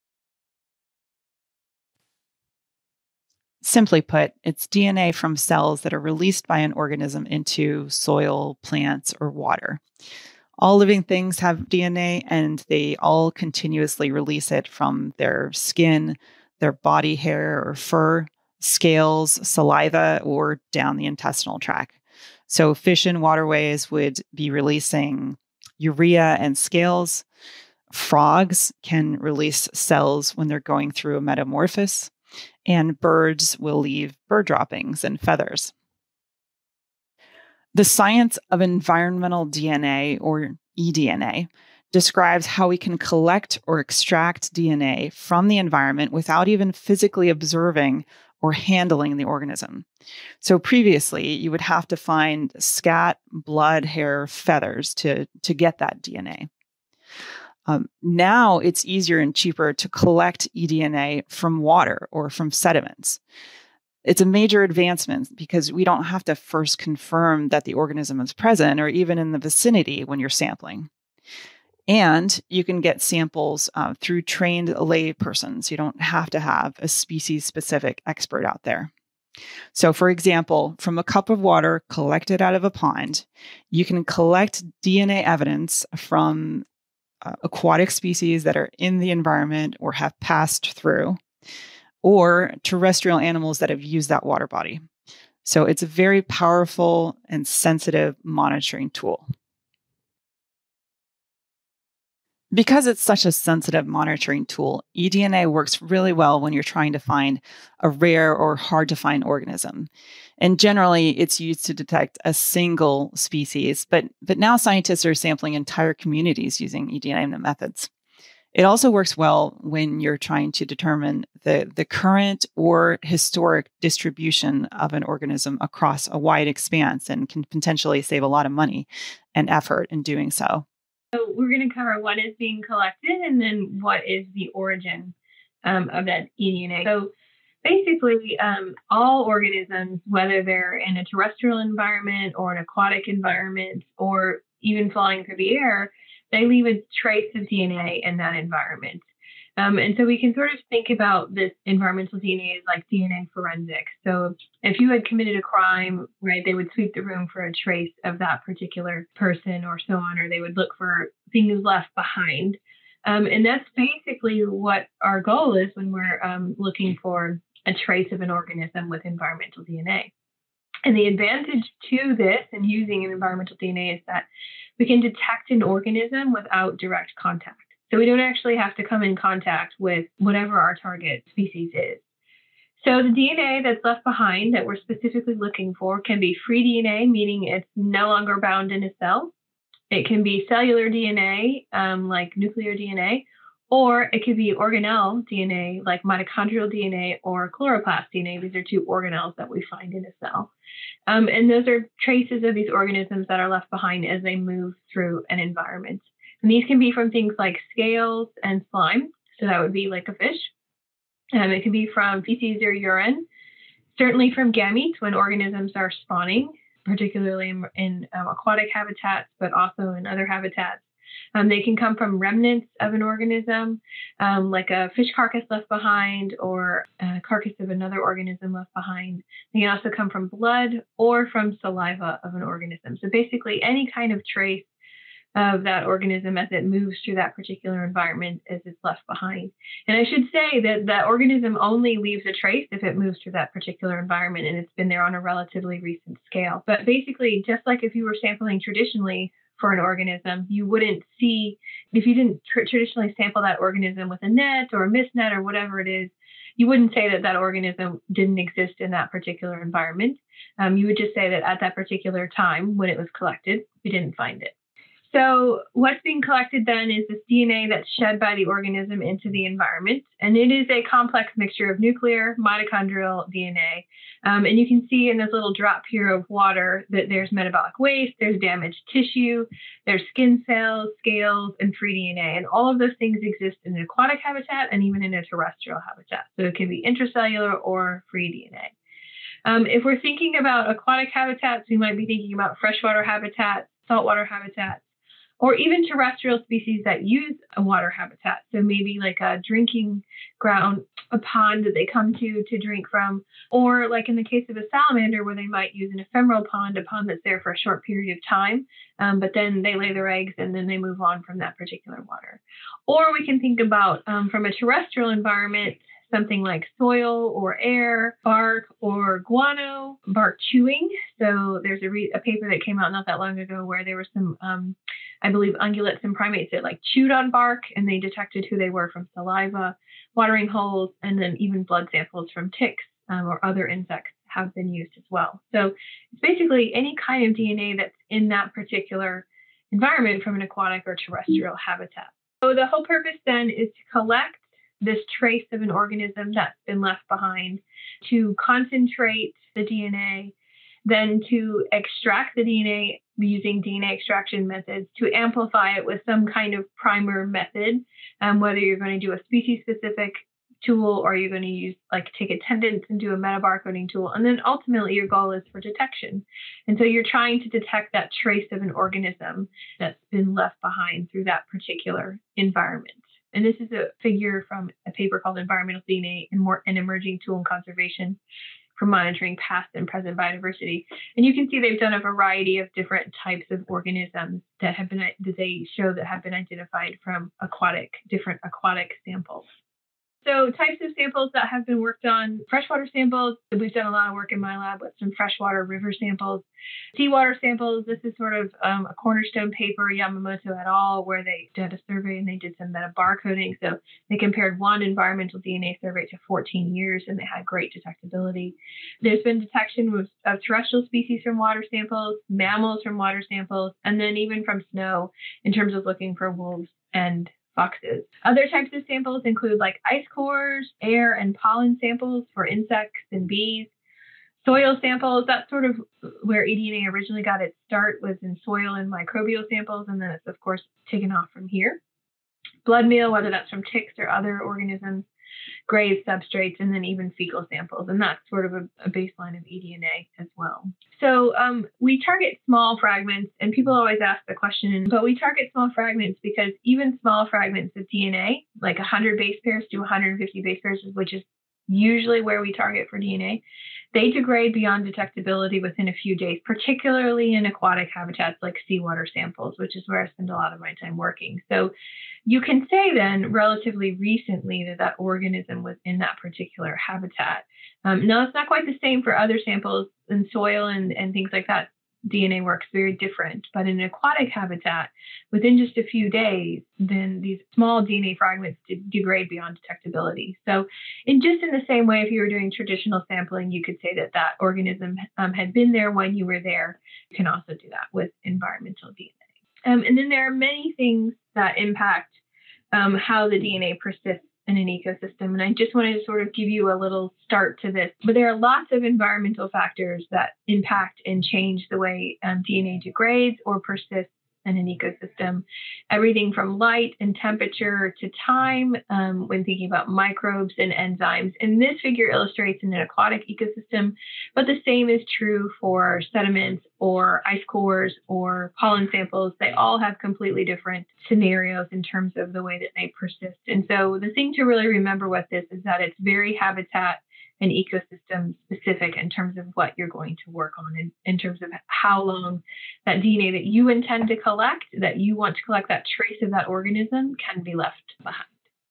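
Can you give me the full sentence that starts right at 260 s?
Um, you would just say that at that particular time when it was collected, we didn't find it.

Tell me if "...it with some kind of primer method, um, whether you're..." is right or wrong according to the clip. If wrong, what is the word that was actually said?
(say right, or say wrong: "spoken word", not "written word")
right.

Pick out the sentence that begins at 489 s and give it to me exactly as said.
Um, and then there are many things that impact um, how the DNA persists in an ecosystem.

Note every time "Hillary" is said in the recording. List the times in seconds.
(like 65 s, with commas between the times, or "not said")
not said.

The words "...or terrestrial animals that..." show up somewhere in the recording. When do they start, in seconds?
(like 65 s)
92 s.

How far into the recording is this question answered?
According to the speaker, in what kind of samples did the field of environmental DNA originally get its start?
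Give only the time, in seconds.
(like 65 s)
428 s.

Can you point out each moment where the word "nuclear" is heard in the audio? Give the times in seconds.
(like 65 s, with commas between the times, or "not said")
192 s, 271 s.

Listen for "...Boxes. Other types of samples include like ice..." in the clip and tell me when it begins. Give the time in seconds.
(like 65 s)
417 s.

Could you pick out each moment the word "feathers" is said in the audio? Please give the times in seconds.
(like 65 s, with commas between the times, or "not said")
35 s, 54 s.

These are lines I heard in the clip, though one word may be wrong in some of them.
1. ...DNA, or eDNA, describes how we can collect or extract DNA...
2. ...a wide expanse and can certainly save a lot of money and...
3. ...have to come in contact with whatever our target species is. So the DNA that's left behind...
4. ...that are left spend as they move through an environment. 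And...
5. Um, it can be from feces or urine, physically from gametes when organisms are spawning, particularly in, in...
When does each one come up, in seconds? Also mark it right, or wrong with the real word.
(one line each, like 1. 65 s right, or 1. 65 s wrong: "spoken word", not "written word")
1. 39 s right
2. 126 s wrong: "potentially", not "certainly"
3. 178 s right
4. 203 s wrong: "behind", not "spend"
5. 211 s wrong: "certainly", not "physically".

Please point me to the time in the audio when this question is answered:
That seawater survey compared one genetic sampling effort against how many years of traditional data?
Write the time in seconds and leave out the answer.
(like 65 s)
406 s.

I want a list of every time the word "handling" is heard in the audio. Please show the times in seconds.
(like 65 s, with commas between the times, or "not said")
48 s.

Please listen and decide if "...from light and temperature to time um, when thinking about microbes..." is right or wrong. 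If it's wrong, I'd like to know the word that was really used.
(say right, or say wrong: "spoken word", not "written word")
right.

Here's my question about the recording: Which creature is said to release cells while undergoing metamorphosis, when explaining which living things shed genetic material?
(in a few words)
Frogs.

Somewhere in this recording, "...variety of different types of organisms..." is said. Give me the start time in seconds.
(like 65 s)
381 s.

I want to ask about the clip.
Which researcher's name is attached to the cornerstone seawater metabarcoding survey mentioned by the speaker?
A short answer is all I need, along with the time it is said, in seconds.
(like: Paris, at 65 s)
Yamamoto, at 399 s.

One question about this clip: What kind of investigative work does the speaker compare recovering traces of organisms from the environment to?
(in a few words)
DNA forensics.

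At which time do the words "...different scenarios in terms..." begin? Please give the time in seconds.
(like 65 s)
520 s.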